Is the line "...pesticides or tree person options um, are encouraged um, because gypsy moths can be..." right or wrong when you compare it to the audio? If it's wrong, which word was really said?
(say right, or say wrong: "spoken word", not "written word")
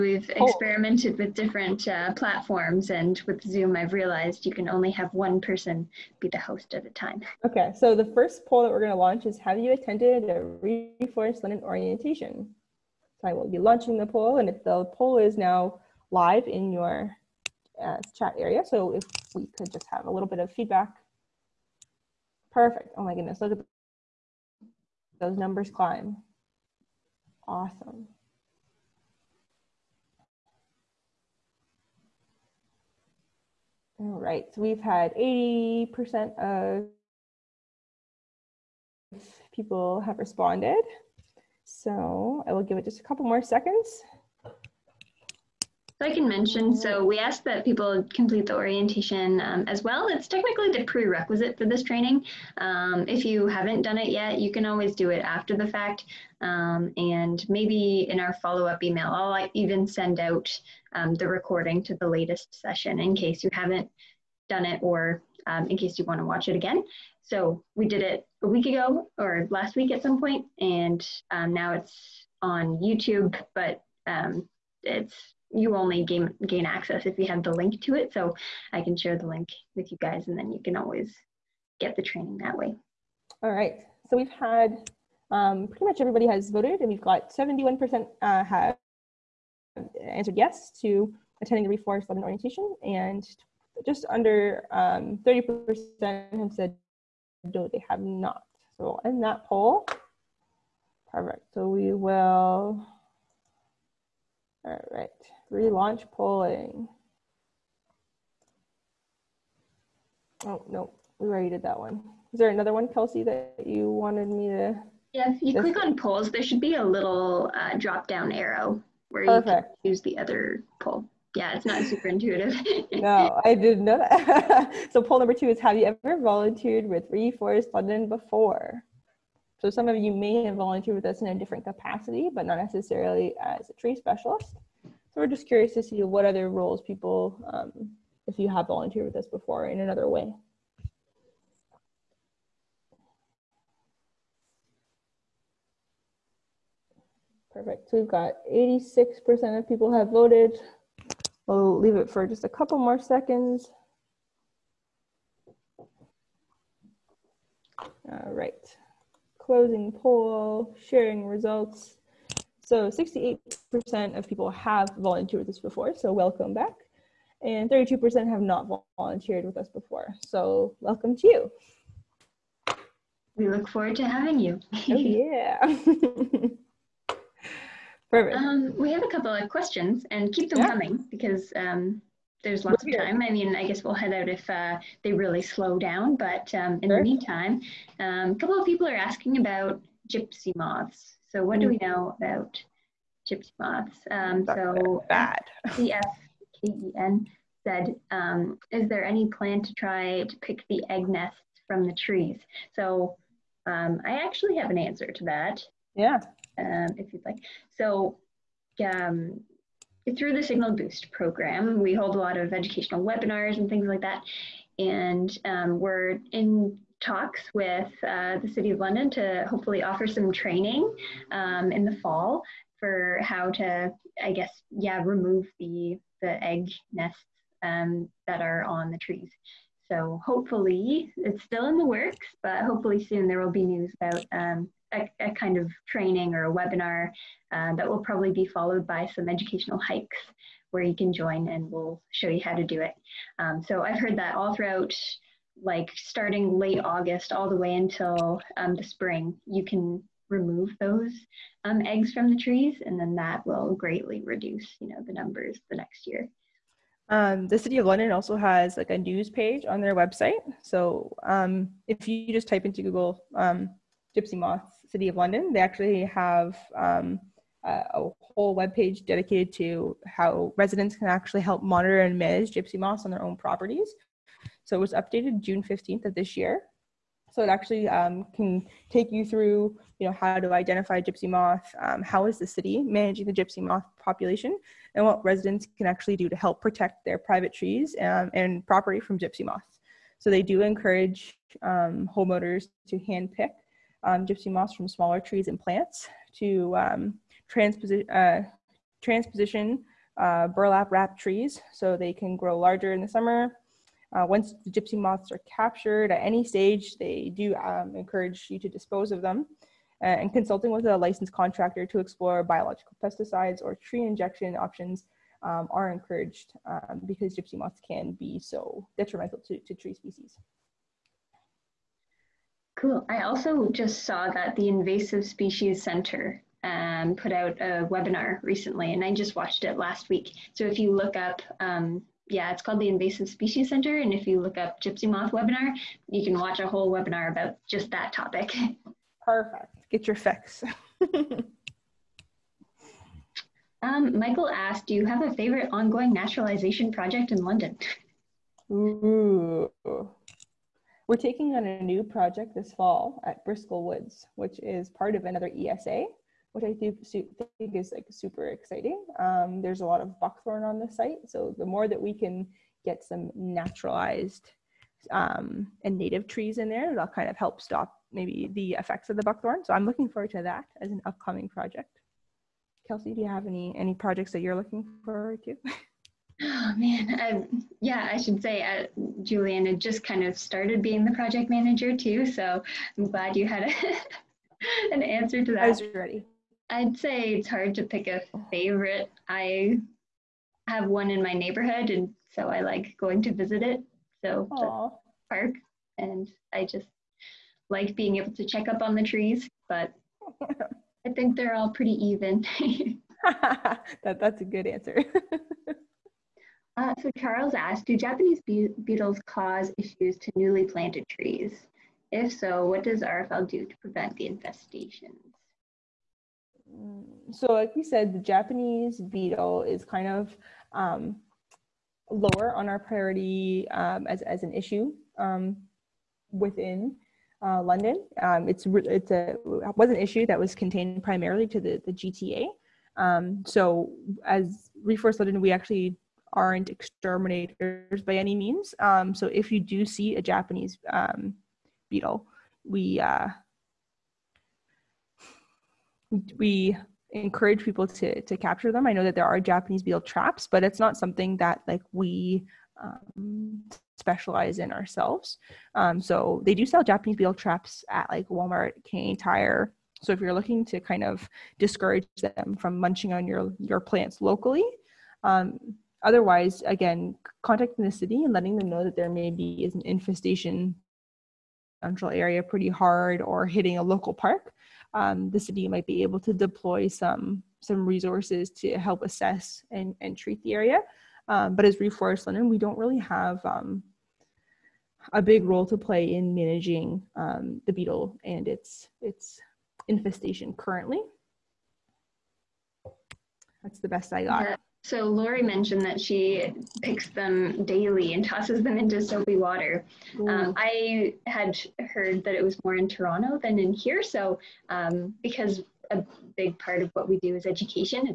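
wrong: "injection", not "person".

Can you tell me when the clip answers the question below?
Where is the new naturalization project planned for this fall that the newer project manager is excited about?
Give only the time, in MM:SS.
05:53.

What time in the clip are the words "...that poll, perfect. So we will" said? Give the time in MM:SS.
01:39.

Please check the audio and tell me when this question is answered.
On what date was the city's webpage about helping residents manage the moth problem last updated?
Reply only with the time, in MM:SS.
04:35.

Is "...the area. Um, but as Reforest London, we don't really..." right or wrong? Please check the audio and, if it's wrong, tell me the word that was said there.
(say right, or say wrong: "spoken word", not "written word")
right.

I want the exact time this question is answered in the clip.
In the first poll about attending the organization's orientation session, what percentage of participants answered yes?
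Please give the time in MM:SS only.
01:27.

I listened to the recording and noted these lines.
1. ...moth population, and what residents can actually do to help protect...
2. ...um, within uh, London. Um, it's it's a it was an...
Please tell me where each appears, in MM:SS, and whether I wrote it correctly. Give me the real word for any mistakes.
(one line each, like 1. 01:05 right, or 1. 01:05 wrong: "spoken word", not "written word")
1. 04:43 right
2. 07:05 right.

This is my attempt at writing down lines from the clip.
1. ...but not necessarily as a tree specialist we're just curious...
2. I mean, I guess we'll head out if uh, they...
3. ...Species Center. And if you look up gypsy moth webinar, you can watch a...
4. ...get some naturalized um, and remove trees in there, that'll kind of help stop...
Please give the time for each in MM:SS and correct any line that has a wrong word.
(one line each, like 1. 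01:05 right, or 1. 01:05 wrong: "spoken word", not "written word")
1. 02:12 right
2. 03:03 right
3. 05:33 right
4. 06:02 wrong: "native", not "remove".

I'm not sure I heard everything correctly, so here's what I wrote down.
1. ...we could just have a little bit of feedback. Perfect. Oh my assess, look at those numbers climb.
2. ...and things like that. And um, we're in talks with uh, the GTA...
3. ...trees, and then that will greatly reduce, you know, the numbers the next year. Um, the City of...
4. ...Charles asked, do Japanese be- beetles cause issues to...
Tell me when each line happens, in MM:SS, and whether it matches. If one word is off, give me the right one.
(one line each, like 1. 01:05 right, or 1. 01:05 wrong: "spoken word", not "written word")
1. 00:19 wrong: "goodness", not "assess"
2. 03:33 wrong: "City", not "GTA"
3. 04:12 right
4. 06:47 right.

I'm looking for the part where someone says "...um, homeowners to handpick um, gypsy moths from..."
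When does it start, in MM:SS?
04:51.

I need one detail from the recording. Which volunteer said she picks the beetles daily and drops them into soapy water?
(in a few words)
Lori.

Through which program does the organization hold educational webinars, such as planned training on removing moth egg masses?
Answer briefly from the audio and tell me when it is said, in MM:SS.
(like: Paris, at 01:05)
Signal Boost, at 03:30.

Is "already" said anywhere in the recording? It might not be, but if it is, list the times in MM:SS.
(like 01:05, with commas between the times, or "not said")
01:51.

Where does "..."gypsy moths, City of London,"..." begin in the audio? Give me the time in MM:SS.
04:24.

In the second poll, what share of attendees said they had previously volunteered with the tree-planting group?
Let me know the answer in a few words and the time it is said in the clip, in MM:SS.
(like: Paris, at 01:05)
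68%, at 02:42.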